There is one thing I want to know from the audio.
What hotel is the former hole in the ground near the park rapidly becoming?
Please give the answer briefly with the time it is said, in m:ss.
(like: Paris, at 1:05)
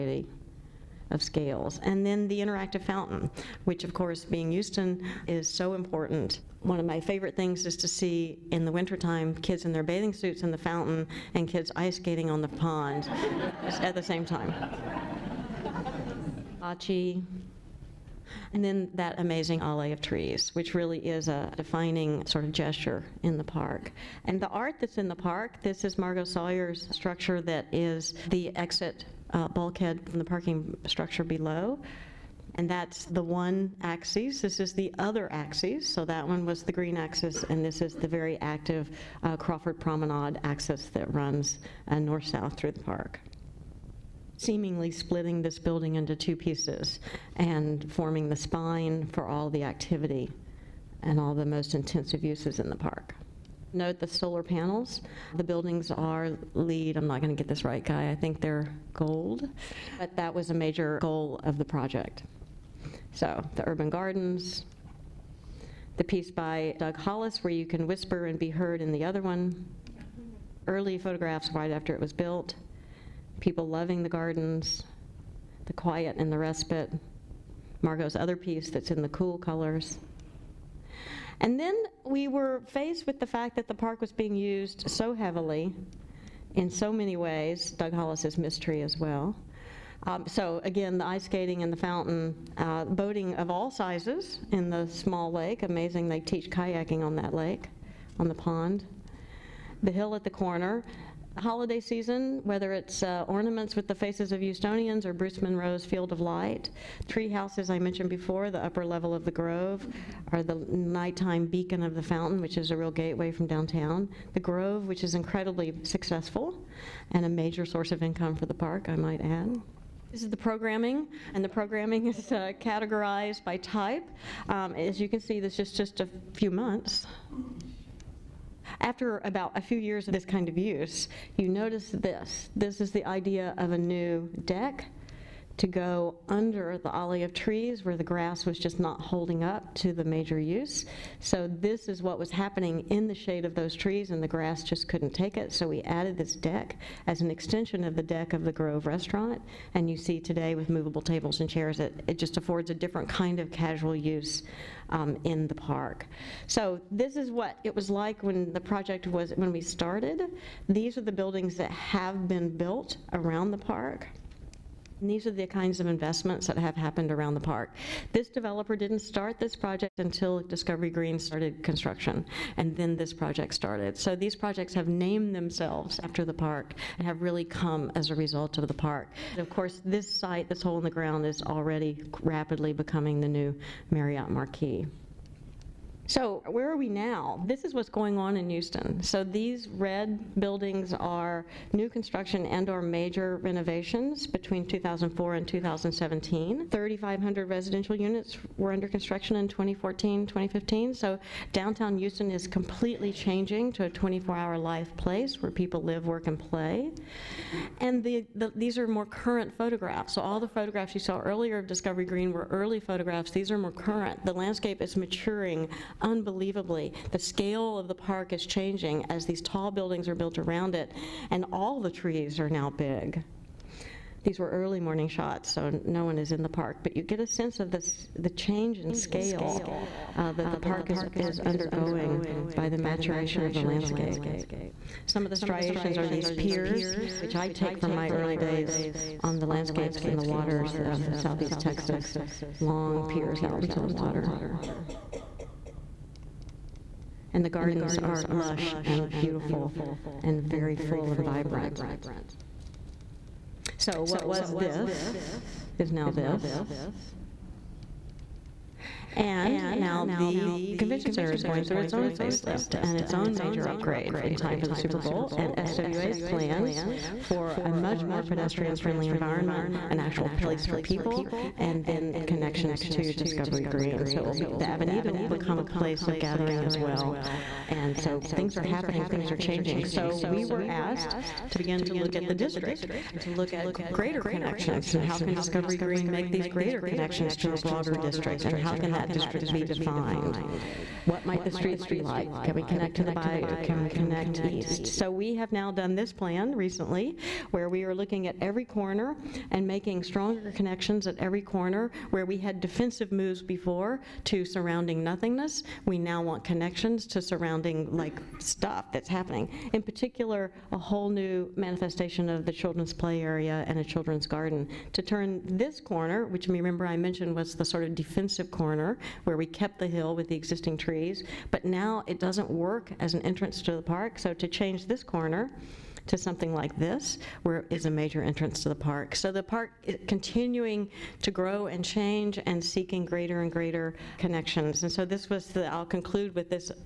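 Marriott Marquis, at 3:03.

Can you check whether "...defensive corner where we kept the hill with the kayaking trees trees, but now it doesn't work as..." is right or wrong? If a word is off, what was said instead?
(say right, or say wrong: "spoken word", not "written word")
wrong: "existing", not "kayaking".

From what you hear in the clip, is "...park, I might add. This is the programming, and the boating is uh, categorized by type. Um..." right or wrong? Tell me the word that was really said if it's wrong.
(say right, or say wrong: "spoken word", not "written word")
wrong: "programming", not "boating".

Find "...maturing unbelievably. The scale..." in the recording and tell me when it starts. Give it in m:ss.
3:34.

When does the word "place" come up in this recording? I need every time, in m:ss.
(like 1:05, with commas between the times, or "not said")
3:24, 4:30, 4:35.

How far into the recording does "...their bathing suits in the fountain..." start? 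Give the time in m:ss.
0:09.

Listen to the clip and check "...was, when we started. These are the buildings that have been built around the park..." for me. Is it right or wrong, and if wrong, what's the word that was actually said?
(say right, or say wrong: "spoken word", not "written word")
right.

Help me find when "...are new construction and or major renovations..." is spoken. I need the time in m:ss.
3:10.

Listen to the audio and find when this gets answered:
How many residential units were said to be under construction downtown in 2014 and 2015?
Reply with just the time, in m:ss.
3:16.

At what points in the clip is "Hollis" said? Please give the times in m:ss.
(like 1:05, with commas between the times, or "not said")
1:06, 1:27.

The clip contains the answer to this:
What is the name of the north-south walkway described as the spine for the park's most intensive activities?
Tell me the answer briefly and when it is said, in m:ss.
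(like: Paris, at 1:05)
Crawford Promenade, at 0:39.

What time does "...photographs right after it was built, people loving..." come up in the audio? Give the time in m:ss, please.
1:10.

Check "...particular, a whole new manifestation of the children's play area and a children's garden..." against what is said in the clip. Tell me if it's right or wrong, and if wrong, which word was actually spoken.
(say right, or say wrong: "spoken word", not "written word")
right.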